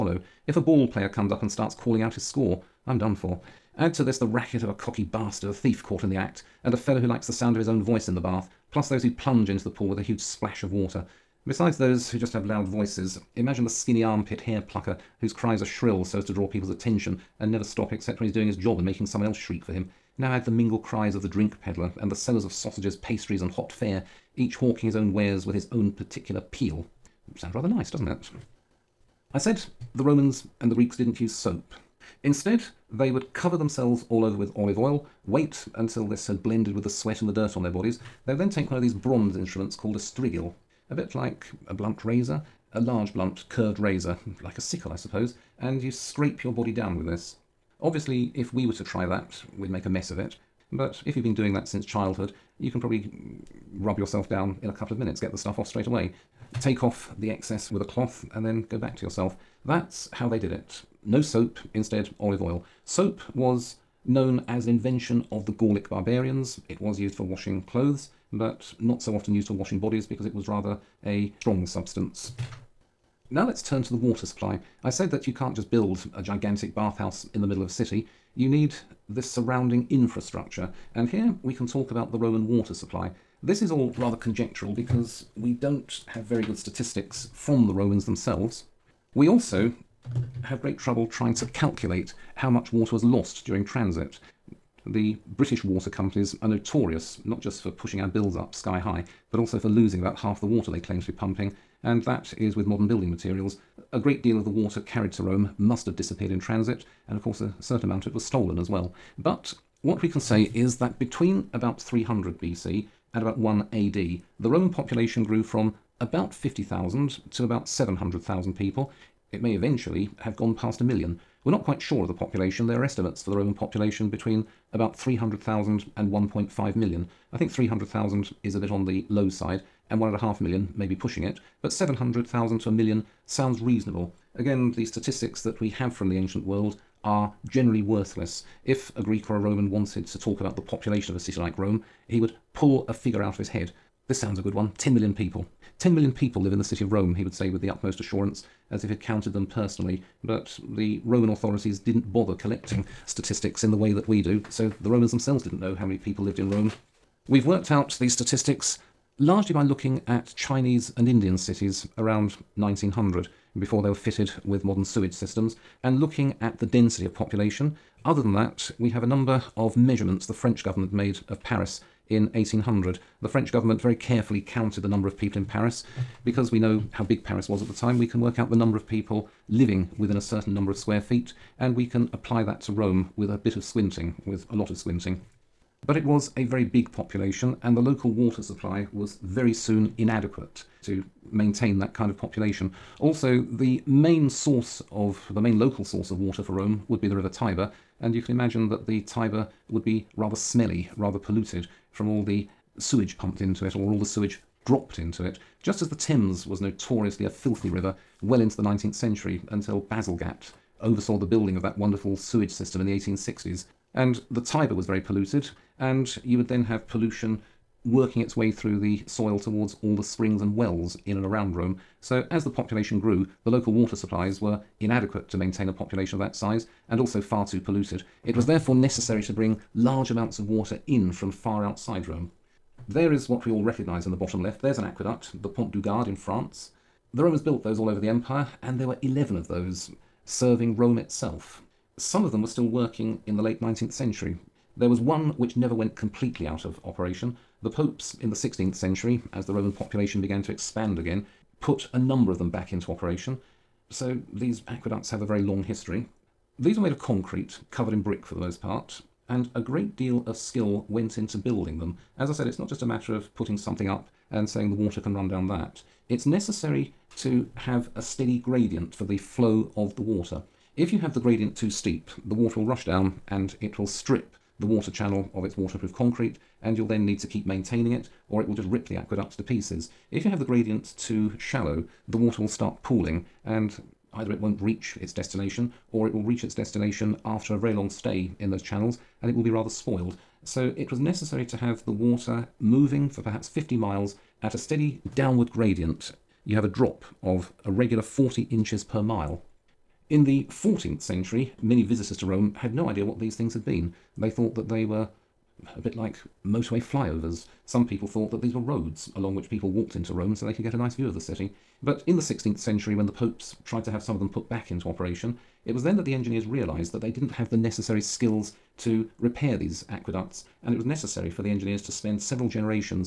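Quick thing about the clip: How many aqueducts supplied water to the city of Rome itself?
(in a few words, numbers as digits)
11.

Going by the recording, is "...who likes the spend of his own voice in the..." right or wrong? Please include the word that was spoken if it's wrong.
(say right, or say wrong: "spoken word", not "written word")
wrong: "sound", not "spend".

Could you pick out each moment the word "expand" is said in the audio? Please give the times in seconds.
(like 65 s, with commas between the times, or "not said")
250 s.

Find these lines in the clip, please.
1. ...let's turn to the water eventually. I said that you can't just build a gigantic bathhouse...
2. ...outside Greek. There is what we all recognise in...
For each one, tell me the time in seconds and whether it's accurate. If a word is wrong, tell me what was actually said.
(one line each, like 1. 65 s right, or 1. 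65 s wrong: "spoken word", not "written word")
1. 73 s wrong: "supply", not "eventually"
2. 231 s wrong: "Rome", not "Greek".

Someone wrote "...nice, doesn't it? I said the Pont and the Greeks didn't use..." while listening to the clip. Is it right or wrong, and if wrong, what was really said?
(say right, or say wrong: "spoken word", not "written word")
wrong: "Romans", not "Pont".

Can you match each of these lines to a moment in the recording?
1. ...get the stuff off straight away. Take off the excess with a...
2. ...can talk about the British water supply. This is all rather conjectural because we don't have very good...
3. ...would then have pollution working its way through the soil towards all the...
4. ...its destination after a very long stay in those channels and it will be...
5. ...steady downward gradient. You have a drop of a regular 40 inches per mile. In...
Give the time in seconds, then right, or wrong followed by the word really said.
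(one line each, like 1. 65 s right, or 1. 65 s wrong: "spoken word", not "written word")
1. 55 s right
2. 81 s wrong: "Roman", not "British"
3. 216 s right
4. 286 s right
5. 294 s right.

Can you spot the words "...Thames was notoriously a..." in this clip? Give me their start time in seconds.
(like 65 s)
205 s.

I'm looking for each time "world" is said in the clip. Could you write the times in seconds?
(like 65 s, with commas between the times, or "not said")
136 s.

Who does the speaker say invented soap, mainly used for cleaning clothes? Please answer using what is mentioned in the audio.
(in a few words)
Gaulic barbarians.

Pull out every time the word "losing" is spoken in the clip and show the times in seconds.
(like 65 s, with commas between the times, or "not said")
99 s.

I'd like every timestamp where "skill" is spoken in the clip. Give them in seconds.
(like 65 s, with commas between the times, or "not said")
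260 s, 318 s.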